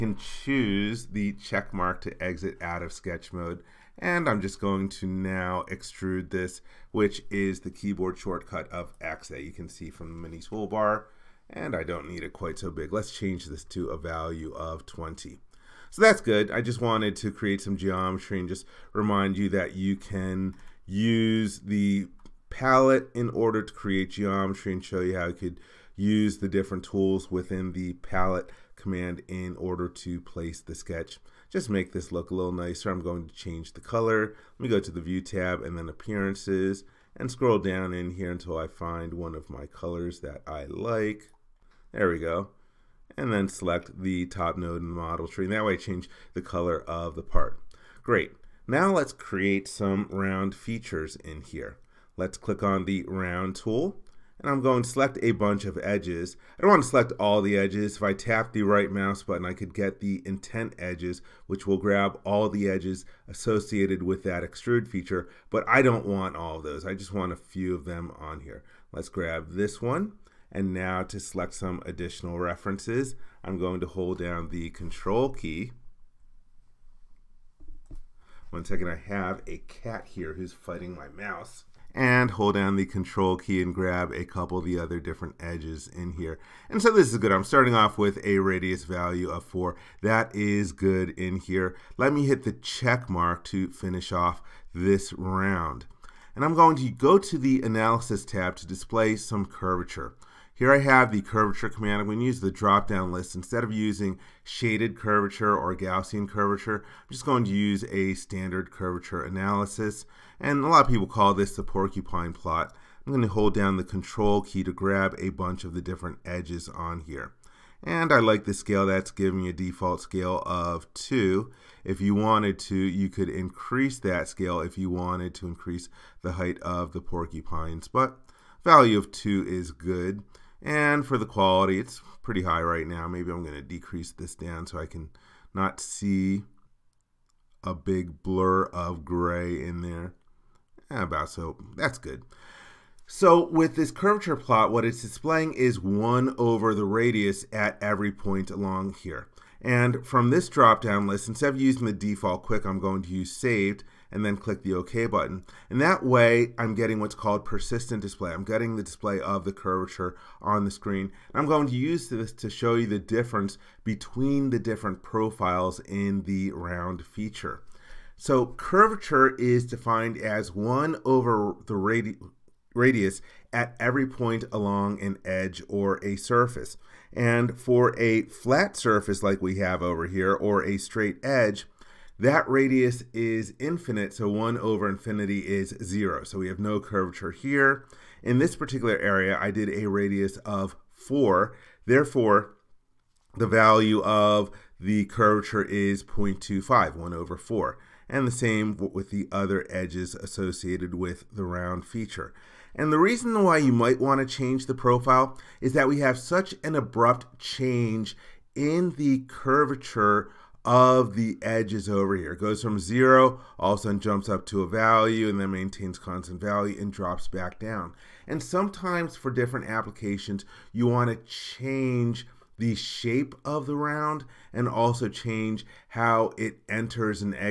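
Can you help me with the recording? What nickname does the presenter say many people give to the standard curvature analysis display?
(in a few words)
porcupine plot.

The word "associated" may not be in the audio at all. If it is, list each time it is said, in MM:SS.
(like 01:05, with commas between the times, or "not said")
01:03, 03:20.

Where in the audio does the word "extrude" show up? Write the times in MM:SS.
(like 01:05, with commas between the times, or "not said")
00:05, 01:04.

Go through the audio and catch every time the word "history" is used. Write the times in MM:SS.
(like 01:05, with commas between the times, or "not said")
not said.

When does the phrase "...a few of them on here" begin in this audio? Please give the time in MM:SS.
01:07.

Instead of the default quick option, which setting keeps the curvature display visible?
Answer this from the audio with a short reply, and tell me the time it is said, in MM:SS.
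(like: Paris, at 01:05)
saved, at 02:33.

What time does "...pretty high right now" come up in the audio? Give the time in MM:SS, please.
02:12.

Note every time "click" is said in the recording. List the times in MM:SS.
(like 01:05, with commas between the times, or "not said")
00:52, 02:34.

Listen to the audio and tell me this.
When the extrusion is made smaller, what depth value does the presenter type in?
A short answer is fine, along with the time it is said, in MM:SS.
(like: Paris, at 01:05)
20, at 00:14.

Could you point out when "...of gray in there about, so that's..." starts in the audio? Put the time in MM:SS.
02:18.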